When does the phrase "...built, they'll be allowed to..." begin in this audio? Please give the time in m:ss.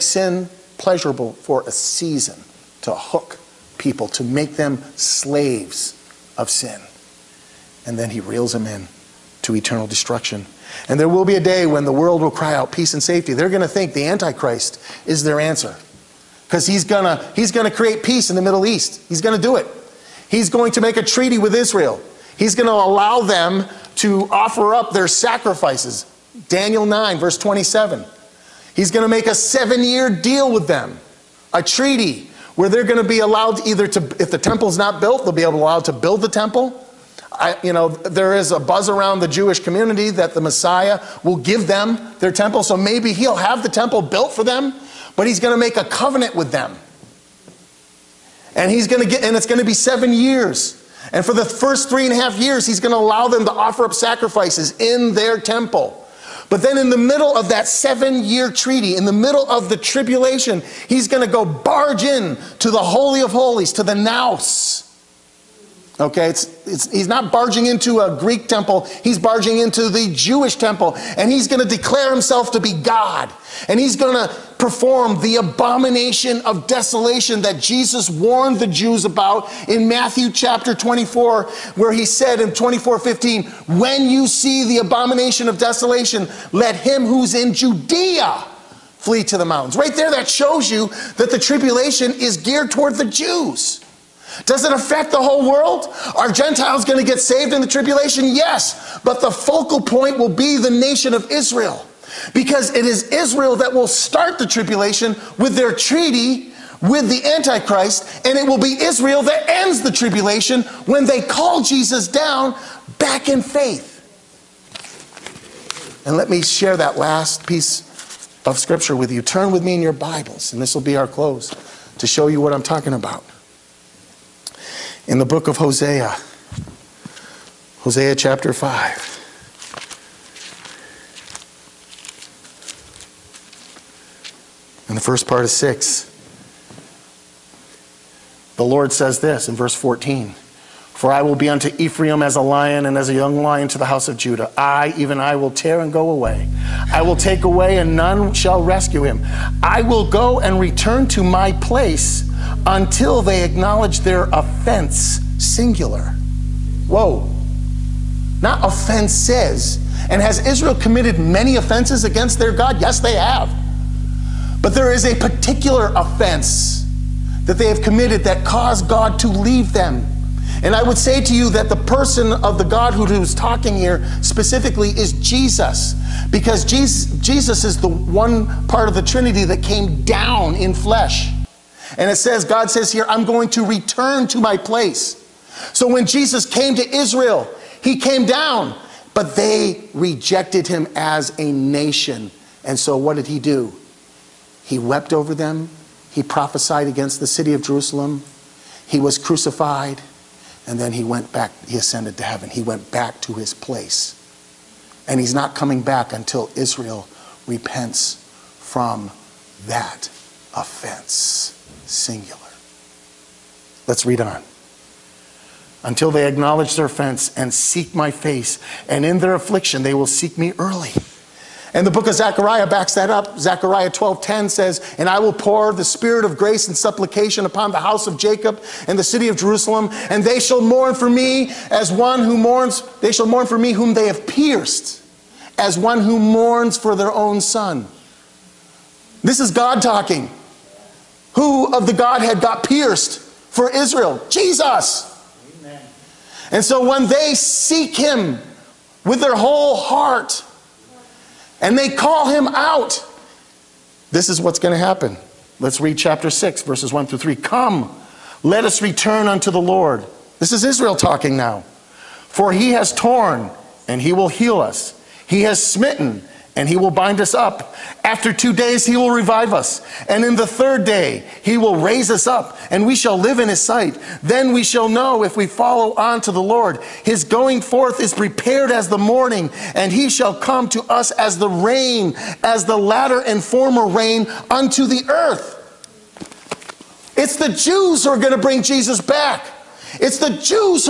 0:34.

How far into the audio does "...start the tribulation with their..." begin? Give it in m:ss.
1:43.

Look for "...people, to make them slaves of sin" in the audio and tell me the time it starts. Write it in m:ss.
0:03.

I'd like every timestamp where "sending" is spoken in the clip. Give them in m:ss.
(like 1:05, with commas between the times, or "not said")
not said.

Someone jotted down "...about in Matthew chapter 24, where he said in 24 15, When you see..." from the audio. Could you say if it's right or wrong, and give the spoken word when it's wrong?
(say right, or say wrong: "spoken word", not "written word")
right.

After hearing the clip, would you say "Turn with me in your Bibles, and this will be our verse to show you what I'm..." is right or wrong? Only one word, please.
wrong.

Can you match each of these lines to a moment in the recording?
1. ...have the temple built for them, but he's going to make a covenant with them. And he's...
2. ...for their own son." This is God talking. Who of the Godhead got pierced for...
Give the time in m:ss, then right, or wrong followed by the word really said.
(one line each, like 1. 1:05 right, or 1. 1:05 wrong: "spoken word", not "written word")
1. 0:43 right
2. 3:56 right.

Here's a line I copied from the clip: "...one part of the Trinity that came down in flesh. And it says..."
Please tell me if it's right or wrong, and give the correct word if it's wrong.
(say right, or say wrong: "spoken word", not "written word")
right.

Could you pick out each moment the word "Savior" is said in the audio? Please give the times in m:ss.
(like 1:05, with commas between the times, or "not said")
not said.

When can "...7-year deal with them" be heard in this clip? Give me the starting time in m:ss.
0:29.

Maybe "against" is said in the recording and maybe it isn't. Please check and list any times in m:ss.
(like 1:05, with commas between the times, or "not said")
2:42, 3:16.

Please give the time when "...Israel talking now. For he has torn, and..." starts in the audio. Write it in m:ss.
4:20.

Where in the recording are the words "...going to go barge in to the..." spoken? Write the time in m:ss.
1:01.